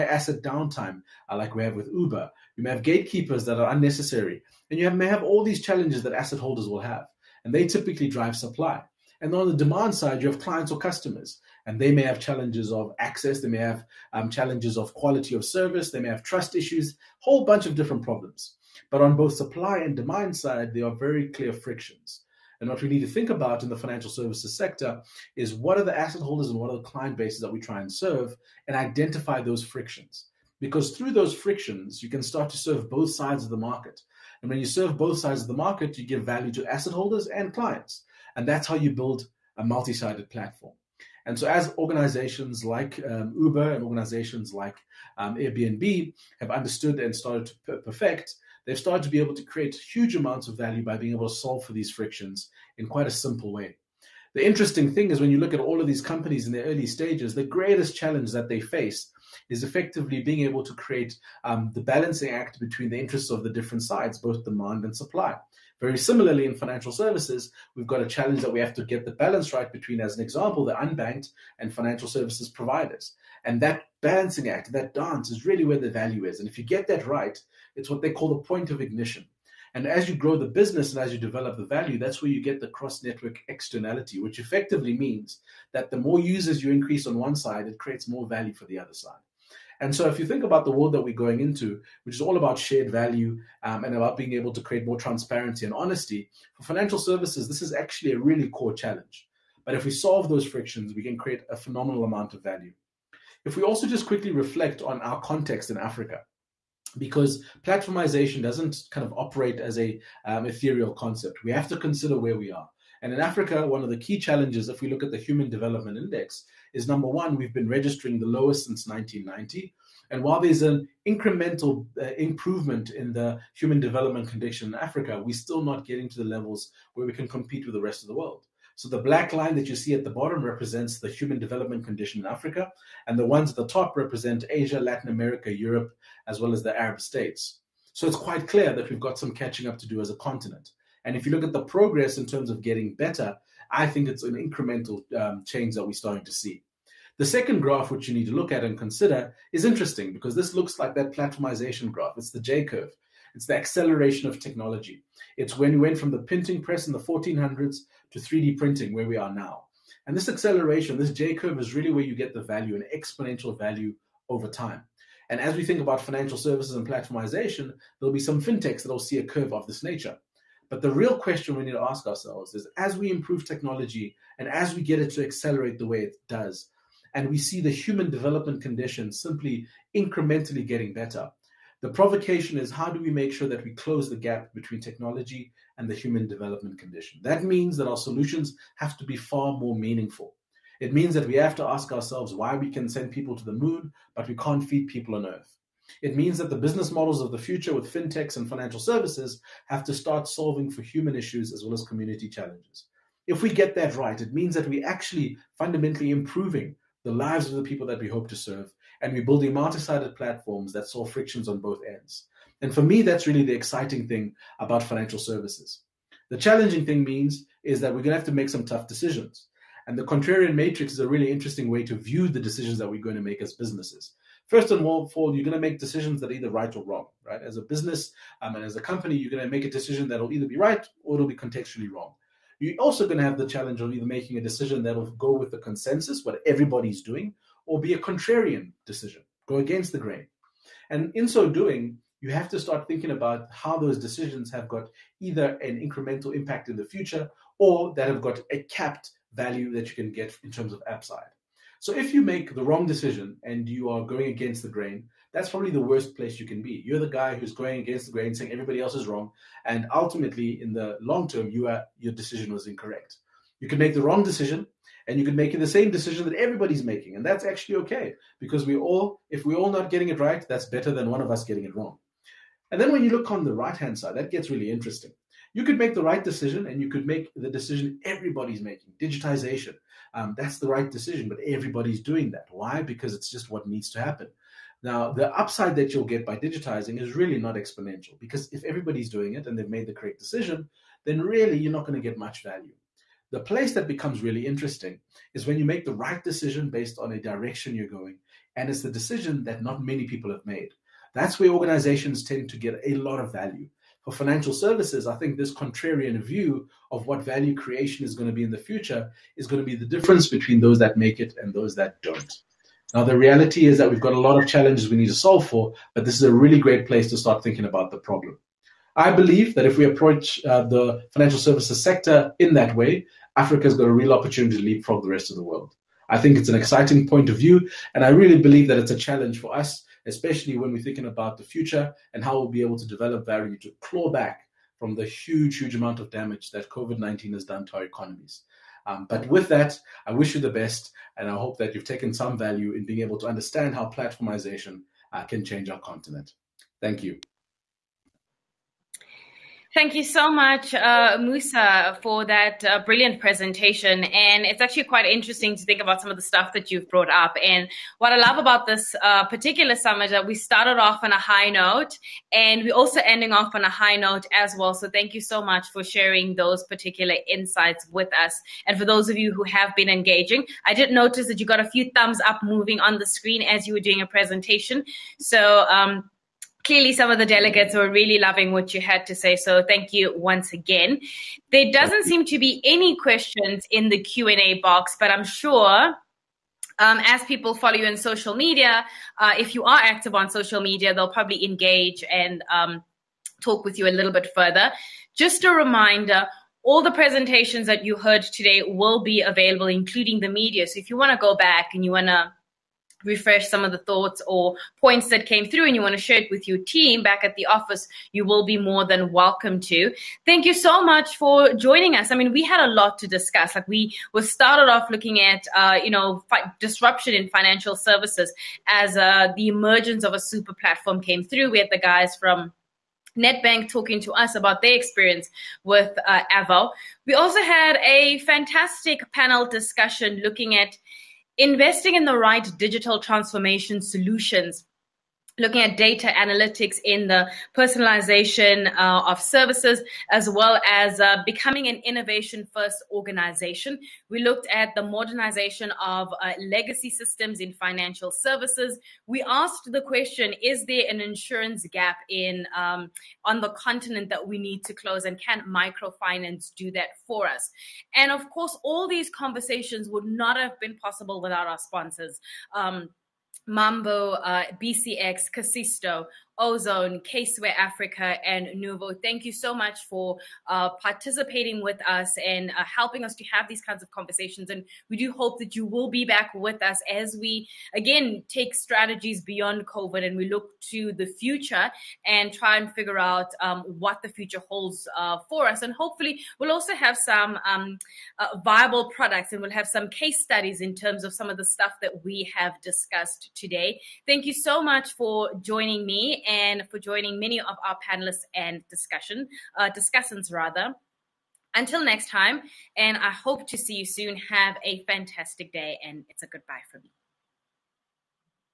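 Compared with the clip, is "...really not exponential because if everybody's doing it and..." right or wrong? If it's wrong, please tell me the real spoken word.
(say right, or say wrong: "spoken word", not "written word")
right.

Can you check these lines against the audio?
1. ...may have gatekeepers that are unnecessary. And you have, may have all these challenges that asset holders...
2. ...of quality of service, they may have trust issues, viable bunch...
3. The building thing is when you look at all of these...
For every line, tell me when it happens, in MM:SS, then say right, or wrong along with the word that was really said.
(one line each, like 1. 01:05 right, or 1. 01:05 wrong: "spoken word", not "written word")
1. 00:02 right
2. 00:14 wrong: "whole", not "viable"
3. 00:54 wrong: "interesting", not "building".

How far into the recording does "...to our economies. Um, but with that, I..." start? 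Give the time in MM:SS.
05:37.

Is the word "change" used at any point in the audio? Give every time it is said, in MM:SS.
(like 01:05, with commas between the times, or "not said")
02:25, 05:45.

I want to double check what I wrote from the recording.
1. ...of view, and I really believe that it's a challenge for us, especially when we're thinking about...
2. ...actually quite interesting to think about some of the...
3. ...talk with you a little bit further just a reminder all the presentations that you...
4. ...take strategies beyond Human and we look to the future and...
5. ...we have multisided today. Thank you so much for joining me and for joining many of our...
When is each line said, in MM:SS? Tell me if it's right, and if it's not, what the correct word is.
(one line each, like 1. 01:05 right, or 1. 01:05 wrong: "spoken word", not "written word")
1. 05:27 right
2. 05:54 right
3. 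06:33 right
4. 07:58 wrong: "COVID", not "Human"
5. 08:12 wrong: "discussed", not "multisided".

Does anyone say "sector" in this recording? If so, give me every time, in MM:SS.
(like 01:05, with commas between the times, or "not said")
00:24, 05:21.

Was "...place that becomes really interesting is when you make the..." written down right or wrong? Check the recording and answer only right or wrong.
right.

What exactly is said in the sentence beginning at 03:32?
And for me, that's really the exciting thing about financial services.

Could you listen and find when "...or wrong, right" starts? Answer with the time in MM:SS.
03:46.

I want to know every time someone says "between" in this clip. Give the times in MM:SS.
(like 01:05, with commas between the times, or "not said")
01:02, 01:09, 03:04, 05:10.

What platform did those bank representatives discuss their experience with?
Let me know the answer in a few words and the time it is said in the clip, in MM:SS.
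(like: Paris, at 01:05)
Avo, at 07:06.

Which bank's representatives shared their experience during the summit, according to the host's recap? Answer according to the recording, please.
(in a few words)
Nedbank.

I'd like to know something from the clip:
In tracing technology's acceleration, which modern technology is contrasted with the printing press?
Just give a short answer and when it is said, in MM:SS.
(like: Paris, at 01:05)
3D printing, at 02:38.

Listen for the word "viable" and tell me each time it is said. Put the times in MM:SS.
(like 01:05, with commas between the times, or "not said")
08:08.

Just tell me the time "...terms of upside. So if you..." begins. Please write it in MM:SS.
04:10.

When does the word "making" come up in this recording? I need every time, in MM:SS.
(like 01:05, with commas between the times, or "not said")
03:54, 04:26, 04:38.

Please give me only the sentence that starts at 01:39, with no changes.
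But if we solve those frictions, we can create a phenomenal amount of value.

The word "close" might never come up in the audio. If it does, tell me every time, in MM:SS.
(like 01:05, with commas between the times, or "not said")
03:03, 07:34.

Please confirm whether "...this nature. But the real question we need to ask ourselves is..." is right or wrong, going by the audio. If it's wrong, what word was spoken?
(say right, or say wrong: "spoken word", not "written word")
right.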